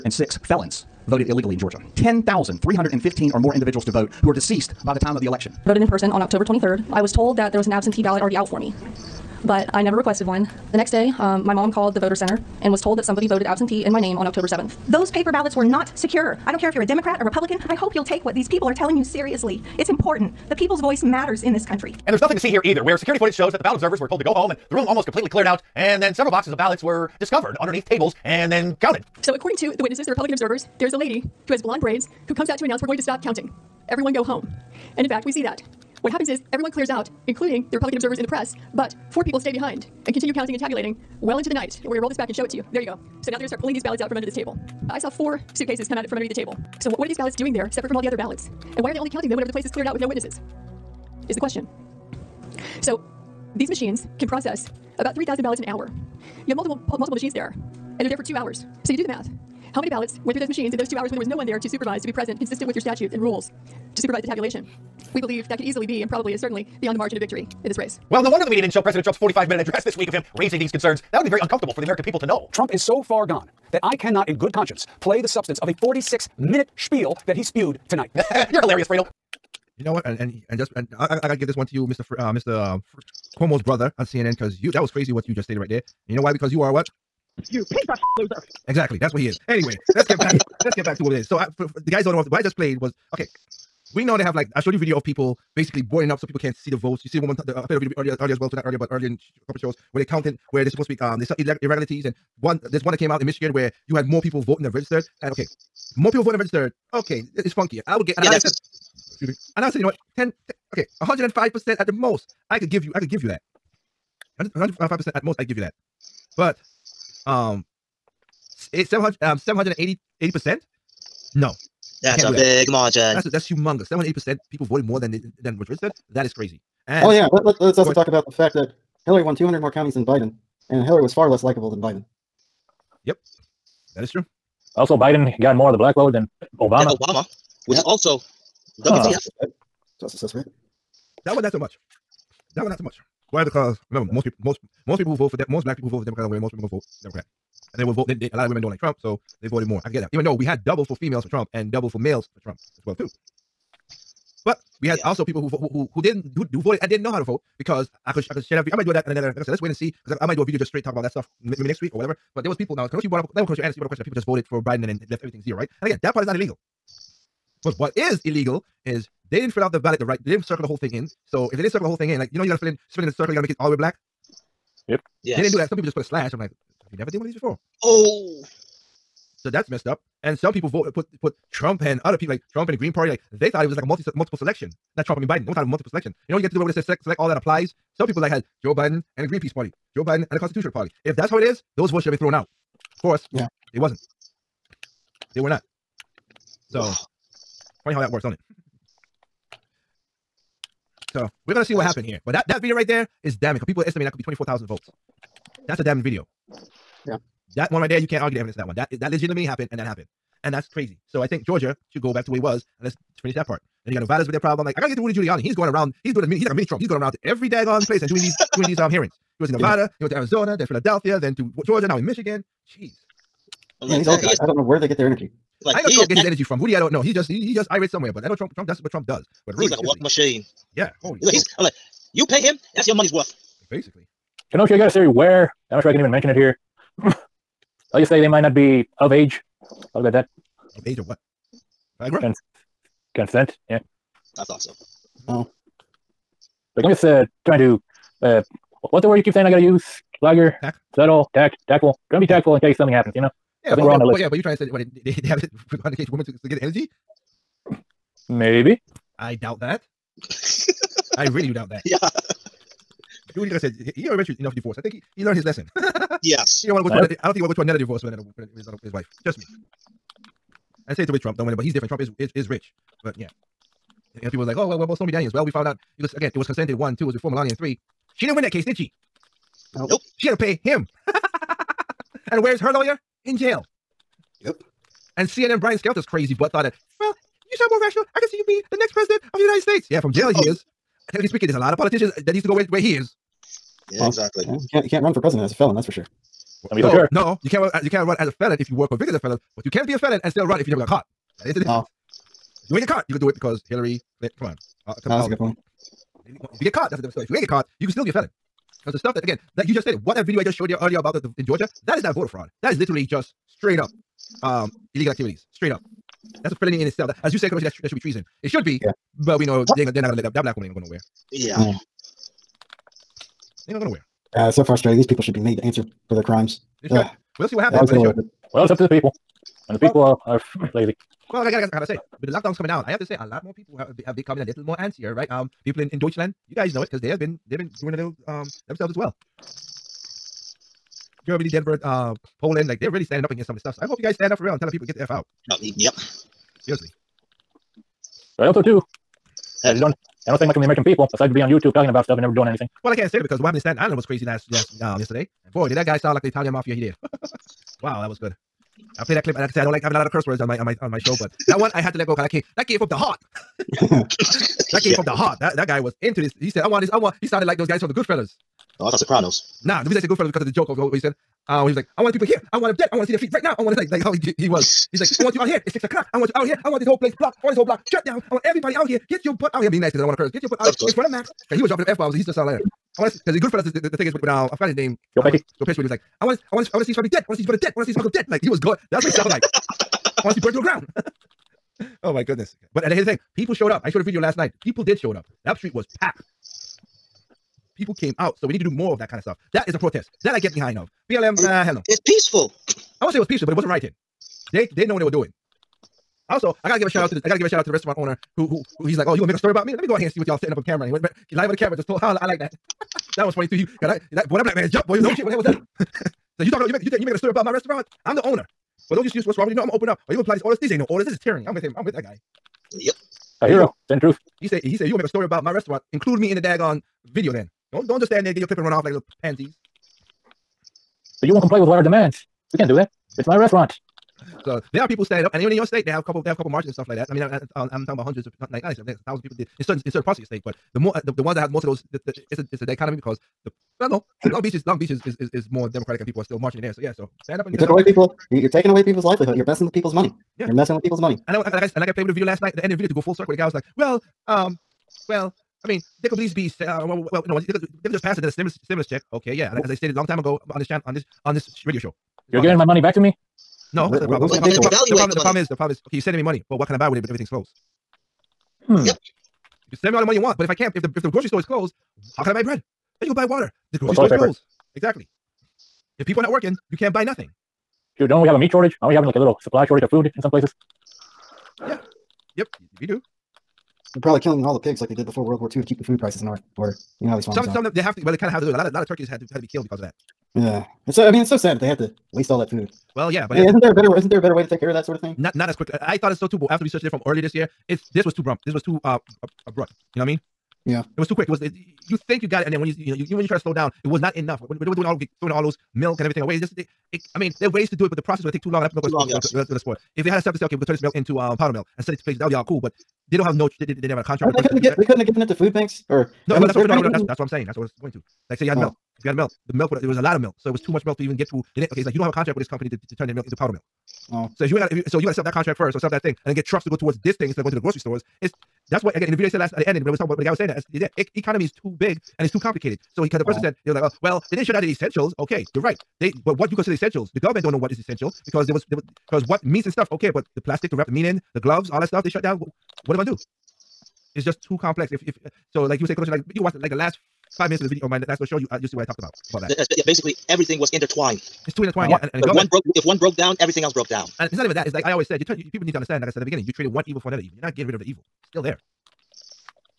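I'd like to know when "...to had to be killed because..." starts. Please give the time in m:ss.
8:09.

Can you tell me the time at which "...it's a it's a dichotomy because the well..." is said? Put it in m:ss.
7:22.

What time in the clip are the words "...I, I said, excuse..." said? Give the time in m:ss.
1:48.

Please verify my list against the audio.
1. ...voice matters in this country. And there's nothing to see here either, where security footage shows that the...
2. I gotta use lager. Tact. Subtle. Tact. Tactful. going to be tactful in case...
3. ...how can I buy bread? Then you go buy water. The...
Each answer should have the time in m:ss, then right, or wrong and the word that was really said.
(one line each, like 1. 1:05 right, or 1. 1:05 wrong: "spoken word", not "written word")
1. 0:20 right
2. 4:09 right
3. 7:52 right.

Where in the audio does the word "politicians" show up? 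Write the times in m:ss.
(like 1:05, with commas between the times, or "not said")
4:51.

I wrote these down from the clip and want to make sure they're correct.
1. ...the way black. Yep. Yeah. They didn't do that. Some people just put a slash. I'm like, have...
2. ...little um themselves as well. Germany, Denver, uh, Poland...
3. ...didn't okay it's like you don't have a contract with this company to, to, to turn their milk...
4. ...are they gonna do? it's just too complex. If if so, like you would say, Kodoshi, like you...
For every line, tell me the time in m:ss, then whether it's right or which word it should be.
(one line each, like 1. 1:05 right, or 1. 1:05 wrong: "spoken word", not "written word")
1. 2:53 right
2. 5:37 right
3. 8:41 right
4. 9:02 right.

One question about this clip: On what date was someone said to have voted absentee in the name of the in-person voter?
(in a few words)
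October 7th.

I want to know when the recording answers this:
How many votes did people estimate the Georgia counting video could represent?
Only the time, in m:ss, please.
3:24.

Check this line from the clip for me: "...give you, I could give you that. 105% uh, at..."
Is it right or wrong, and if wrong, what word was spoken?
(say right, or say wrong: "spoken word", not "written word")
right.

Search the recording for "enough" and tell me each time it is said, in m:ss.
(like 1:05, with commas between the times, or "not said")
4:24, 8:24.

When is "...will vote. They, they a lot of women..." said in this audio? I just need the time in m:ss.
2:27.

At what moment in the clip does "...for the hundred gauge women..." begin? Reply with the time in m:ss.
4:15.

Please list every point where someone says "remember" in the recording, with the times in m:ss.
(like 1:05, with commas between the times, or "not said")
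2:23.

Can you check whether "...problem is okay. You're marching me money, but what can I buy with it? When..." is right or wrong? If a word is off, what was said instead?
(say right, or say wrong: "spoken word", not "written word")
wrong: "sending", not "marching".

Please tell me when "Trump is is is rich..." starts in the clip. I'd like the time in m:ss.
4:31.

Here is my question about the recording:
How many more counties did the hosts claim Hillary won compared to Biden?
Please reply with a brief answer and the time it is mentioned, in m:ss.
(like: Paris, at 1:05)
200, at 2:09.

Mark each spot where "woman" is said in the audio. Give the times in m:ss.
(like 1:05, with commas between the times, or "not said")
1:37, 5:20.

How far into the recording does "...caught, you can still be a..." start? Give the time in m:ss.
5:07.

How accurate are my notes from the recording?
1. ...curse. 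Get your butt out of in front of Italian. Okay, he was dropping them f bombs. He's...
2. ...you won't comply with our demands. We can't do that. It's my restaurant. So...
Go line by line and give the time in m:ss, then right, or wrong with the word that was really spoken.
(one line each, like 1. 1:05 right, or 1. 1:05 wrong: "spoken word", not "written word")
1. 6:20 wrong: "Max", not "Italian"
2. 7:11 right.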